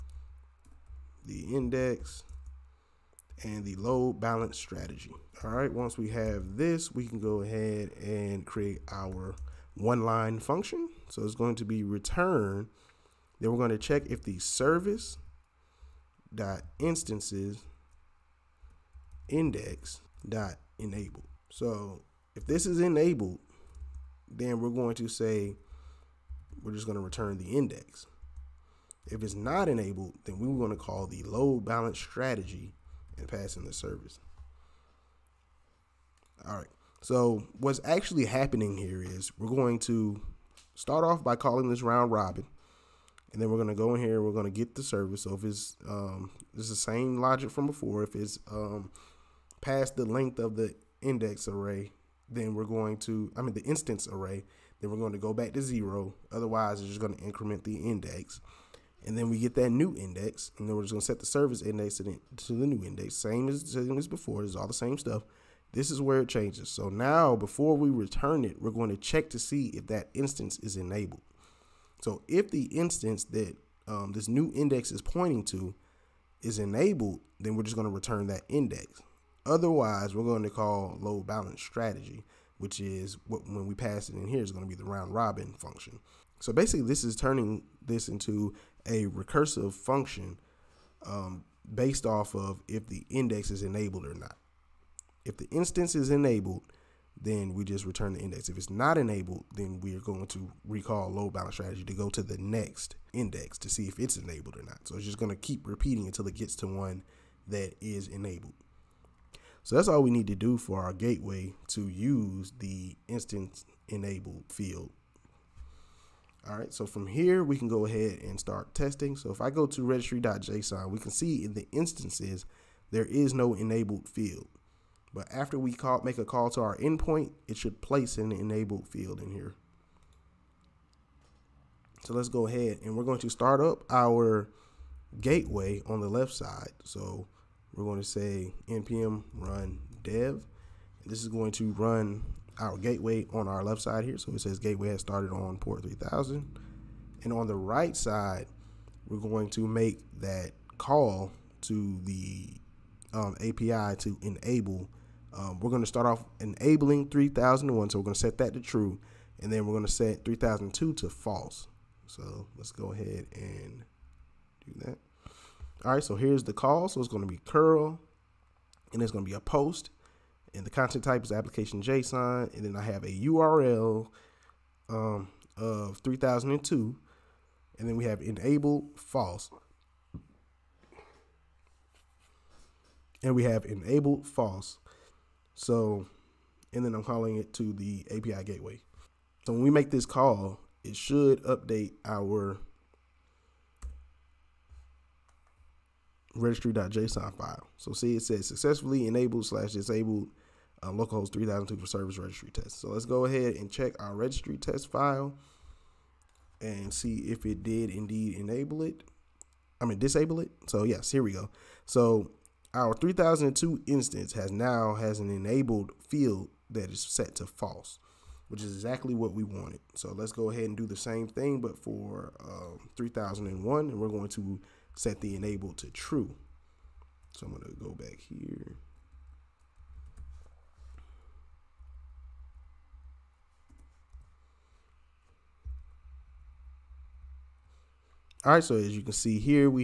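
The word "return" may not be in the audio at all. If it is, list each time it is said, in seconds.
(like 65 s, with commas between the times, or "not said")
11 s, 27 s, 67 s, 77 s, 97 s.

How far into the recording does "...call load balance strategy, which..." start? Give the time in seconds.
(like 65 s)
80 s.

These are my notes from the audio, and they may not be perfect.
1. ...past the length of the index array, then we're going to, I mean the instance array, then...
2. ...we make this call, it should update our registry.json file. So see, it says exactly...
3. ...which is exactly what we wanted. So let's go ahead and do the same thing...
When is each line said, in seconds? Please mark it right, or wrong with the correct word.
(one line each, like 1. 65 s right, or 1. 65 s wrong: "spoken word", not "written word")
1. 49 s right
2. 189 s wrong: "successfully", not "exactly"
3. 218 s right.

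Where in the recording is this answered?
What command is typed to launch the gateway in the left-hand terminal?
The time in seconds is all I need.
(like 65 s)
138 s.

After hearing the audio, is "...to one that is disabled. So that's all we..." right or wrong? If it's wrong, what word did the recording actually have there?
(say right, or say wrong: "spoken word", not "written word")
wrong: "enabled", not "disabled".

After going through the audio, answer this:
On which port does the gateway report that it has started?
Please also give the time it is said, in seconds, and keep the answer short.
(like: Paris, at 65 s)
3000, at 145 s.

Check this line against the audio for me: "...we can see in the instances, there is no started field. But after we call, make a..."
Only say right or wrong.
wrong.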